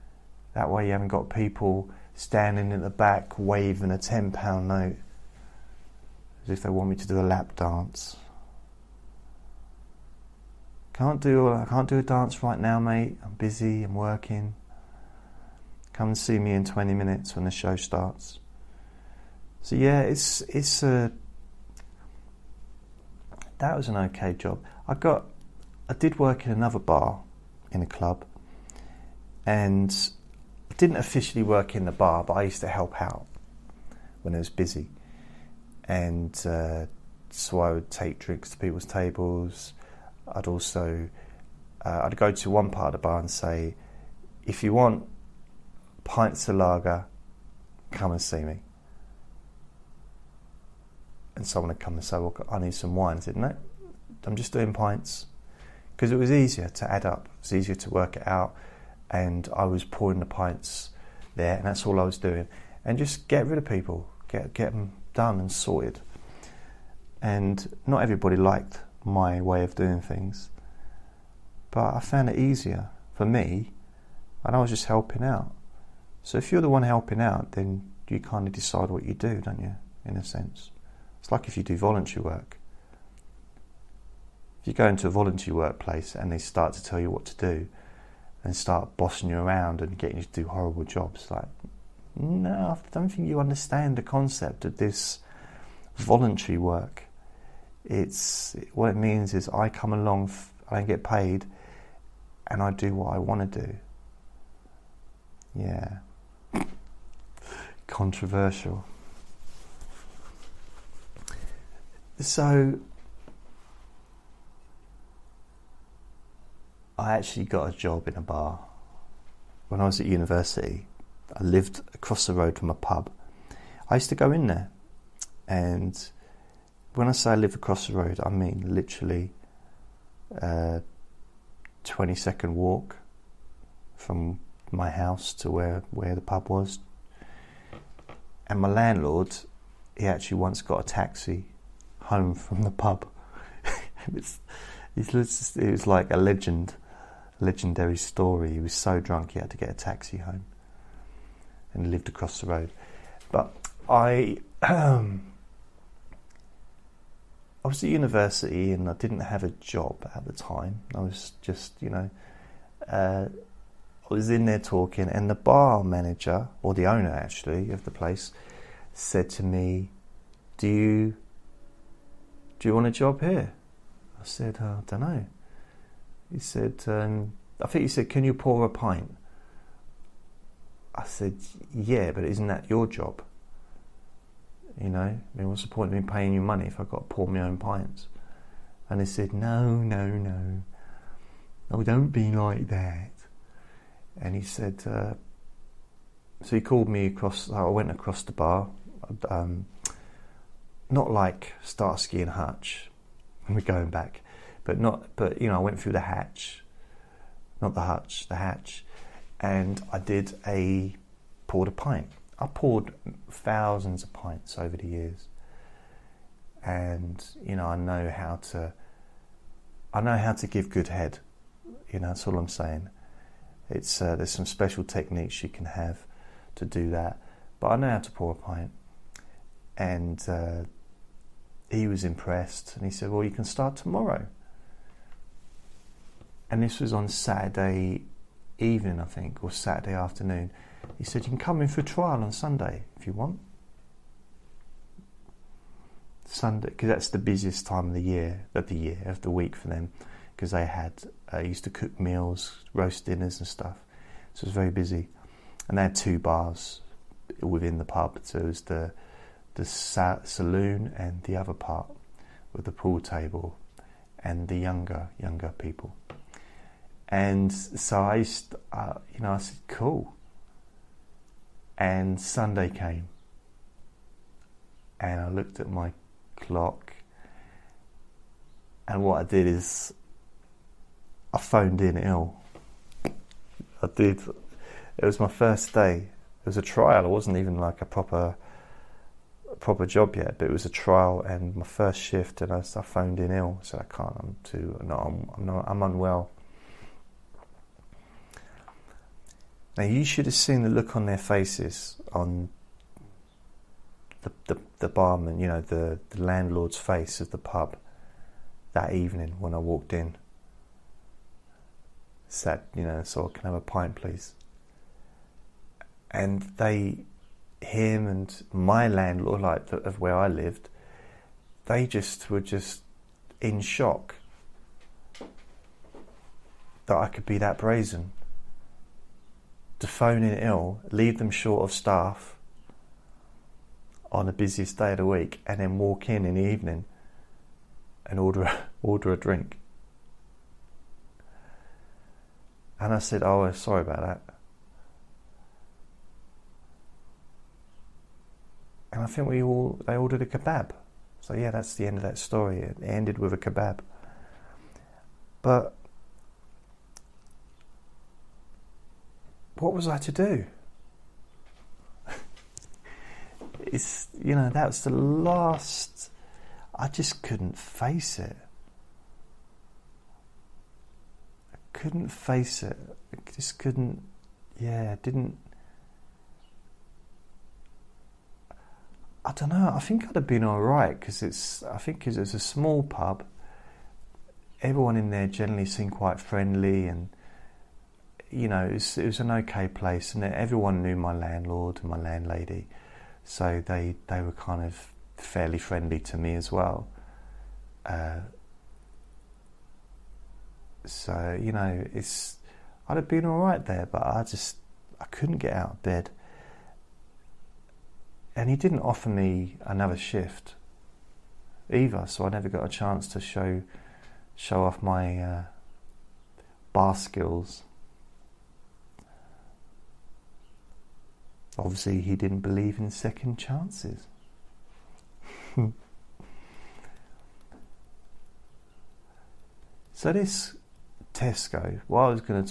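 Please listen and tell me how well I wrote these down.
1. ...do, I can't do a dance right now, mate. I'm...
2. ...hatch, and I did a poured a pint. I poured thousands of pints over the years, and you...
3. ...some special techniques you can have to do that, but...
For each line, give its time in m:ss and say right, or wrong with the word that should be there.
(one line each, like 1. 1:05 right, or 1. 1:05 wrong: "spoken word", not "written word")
1. 0:11 right
2. 3:28 right
3. 3:44 right.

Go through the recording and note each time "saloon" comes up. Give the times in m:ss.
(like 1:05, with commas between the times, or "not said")
4:20.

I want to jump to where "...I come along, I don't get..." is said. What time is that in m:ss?
1:39.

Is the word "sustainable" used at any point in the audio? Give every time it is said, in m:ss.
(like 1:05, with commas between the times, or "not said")
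not said.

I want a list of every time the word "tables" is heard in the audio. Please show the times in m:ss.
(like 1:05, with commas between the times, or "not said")
0:38, 4:22.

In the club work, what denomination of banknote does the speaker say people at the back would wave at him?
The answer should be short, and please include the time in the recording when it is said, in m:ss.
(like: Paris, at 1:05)
£10, at 0:03.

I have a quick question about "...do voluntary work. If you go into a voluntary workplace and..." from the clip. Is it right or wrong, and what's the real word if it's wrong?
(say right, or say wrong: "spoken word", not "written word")
right.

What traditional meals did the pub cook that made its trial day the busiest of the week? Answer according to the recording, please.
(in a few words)
Roast dinners.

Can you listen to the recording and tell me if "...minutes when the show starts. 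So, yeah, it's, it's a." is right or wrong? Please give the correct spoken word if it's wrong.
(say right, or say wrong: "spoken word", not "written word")
right.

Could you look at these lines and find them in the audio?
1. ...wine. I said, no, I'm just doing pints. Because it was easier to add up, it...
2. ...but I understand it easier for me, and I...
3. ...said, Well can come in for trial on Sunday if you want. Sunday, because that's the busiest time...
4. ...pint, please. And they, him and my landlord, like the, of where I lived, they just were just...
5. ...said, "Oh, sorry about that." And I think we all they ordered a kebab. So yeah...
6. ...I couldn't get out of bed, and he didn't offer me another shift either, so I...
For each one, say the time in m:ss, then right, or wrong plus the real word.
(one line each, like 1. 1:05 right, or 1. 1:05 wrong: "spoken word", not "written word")
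1. 0:52 right
2. 1:11 wrong: "found", not "understand"
3. 4:01 wrong: "You", not "Well"
4. 5:13 right
5. 5:42 right
6. 6:44 right.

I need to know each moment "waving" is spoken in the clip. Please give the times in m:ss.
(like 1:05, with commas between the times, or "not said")
0:03.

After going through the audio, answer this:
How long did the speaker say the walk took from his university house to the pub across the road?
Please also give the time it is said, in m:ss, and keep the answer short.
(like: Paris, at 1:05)
20 seconds, at 2:11.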